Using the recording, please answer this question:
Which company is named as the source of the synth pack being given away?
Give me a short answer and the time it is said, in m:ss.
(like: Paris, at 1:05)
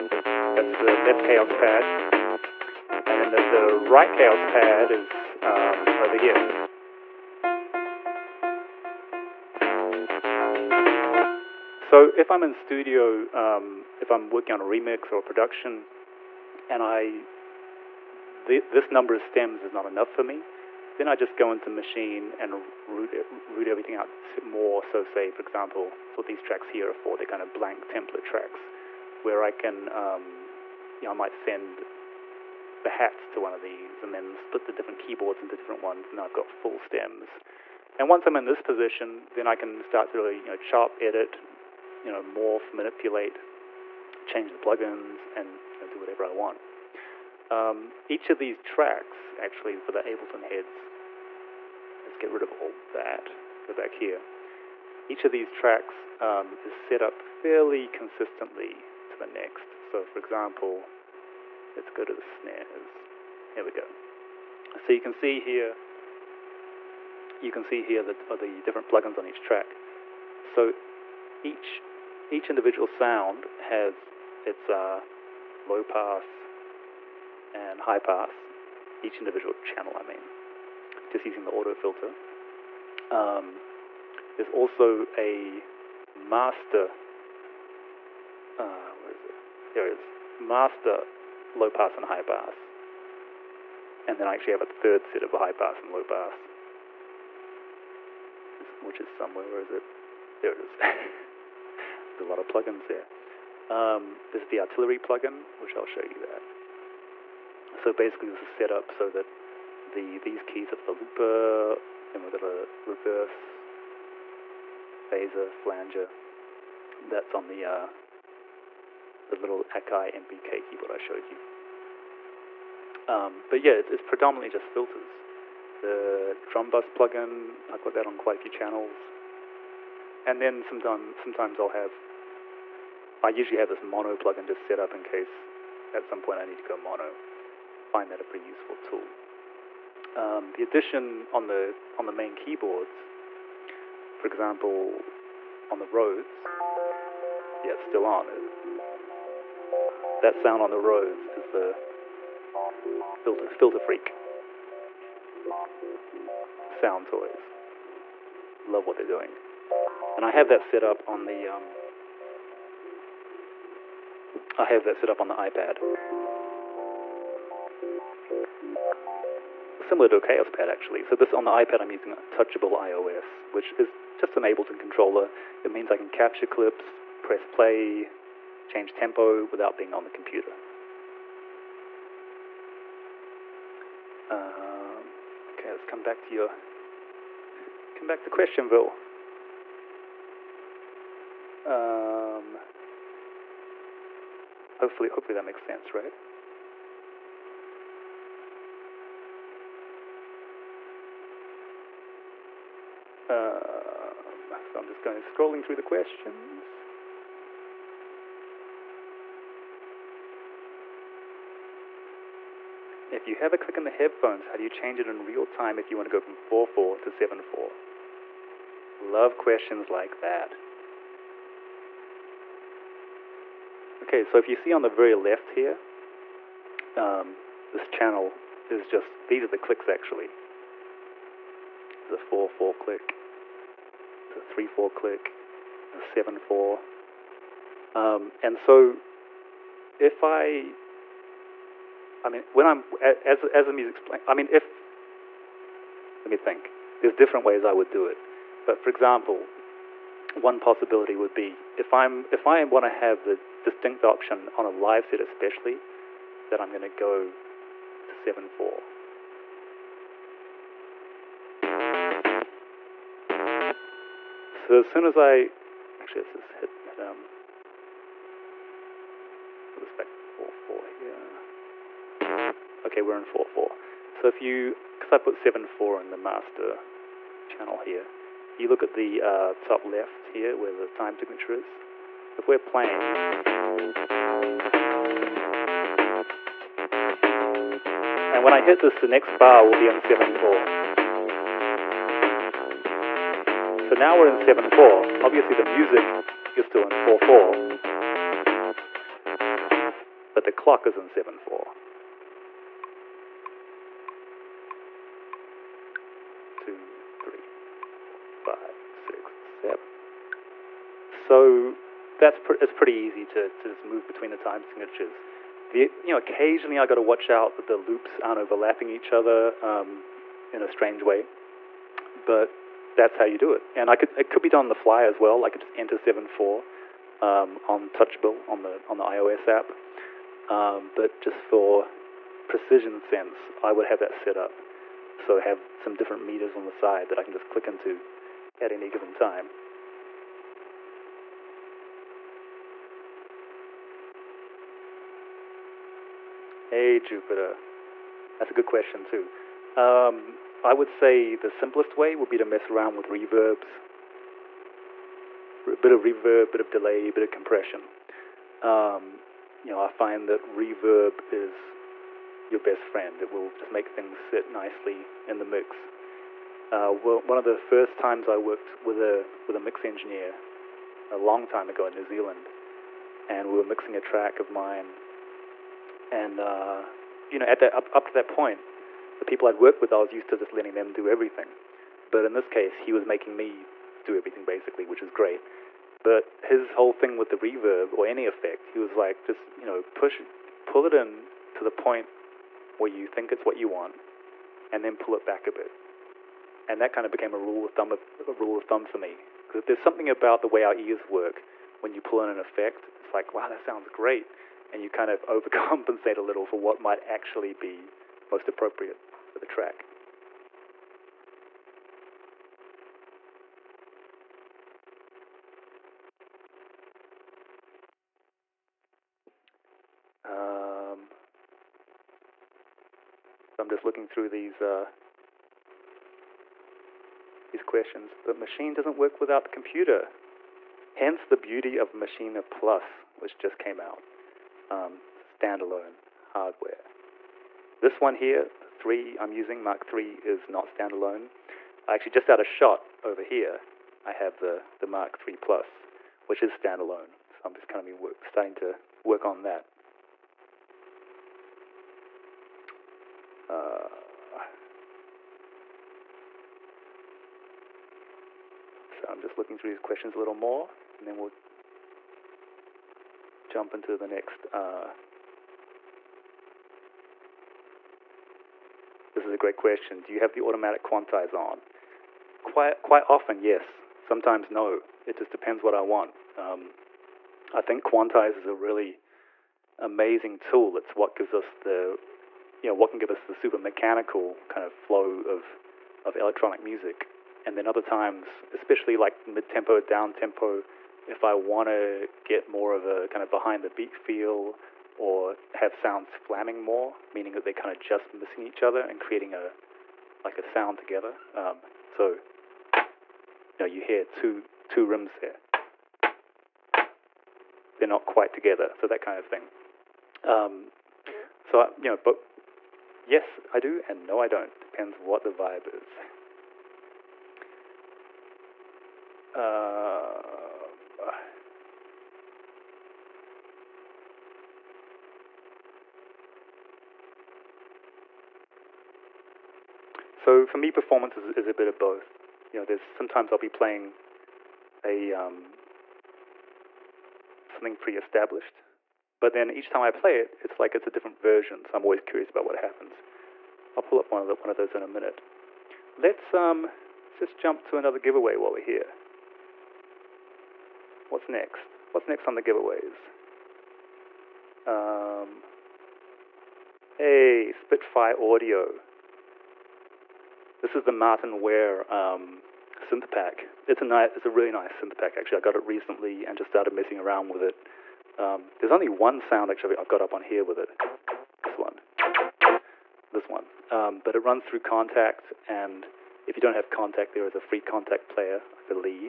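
Spitfire Audio, at 9:17.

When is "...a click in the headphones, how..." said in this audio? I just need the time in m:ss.
3:33.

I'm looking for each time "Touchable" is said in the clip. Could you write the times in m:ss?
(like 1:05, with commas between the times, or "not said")
2:52, 5:27.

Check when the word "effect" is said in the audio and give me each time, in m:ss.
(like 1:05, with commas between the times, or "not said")
6:28, 6:42.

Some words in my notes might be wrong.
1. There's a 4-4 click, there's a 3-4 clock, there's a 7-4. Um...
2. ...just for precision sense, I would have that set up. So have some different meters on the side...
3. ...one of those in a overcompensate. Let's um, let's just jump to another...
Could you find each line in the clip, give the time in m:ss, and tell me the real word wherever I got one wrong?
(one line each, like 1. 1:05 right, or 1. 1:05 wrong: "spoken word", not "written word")
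1. 3:52 wrong: "click", not "clock"
2. 5:31 right
3. 9:04 wrong: "minute", not "overcompensate".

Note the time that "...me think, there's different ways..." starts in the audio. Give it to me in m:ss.
4:06.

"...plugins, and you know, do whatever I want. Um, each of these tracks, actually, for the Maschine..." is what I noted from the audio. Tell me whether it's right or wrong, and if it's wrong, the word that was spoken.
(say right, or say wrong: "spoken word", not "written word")
wrong: "Ableton", not "Maschine".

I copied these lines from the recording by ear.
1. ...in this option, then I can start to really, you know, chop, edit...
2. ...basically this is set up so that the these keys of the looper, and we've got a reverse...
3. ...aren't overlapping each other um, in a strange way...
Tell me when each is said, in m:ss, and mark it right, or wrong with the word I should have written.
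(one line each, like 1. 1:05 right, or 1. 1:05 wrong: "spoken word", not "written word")
1. 0:38 wrong: "position", not "option"
2. 1:47 right
3. 5:18 right.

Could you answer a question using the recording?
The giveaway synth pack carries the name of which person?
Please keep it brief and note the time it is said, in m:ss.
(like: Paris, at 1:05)
Martyn Ware, at 9:20.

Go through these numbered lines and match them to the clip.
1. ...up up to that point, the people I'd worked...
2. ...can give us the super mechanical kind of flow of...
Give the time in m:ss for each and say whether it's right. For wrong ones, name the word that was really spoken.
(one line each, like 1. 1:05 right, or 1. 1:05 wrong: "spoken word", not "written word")
1. 6:17 right
2. 8:02 right.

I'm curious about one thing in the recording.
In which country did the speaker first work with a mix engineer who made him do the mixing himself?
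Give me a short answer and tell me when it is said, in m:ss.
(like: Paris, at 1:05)
New Zealand, at 6:11.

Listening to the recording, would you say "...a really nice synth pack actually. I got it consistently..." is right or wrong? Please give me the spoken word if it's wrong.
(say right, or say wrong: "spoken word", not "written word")
wrong: "recently", not "consistently".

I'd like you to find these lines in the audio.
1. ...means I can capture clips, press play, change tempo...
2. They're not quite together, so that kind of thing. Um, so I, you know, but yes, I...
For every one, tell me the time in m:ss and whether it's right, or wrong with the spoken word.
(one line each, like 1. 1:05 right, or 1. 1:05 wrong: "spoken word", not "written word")
1. 2:55 right
2. 8:27 right.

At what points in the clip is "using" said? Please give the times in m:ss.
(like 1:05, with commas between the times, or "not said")
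1:21, 2:51, 7:19.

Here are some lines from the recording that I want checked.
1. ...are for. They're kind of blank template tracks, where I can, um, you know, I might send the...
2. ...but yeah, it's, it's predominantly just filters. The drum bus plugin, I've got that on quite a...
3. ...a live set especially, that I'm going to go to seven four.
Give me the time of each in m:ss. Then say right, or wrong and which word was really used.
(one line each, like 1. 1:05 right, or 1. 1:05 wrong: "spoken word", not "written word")
1. 0:26 right
2. 2:03 right
3. 4:14 right.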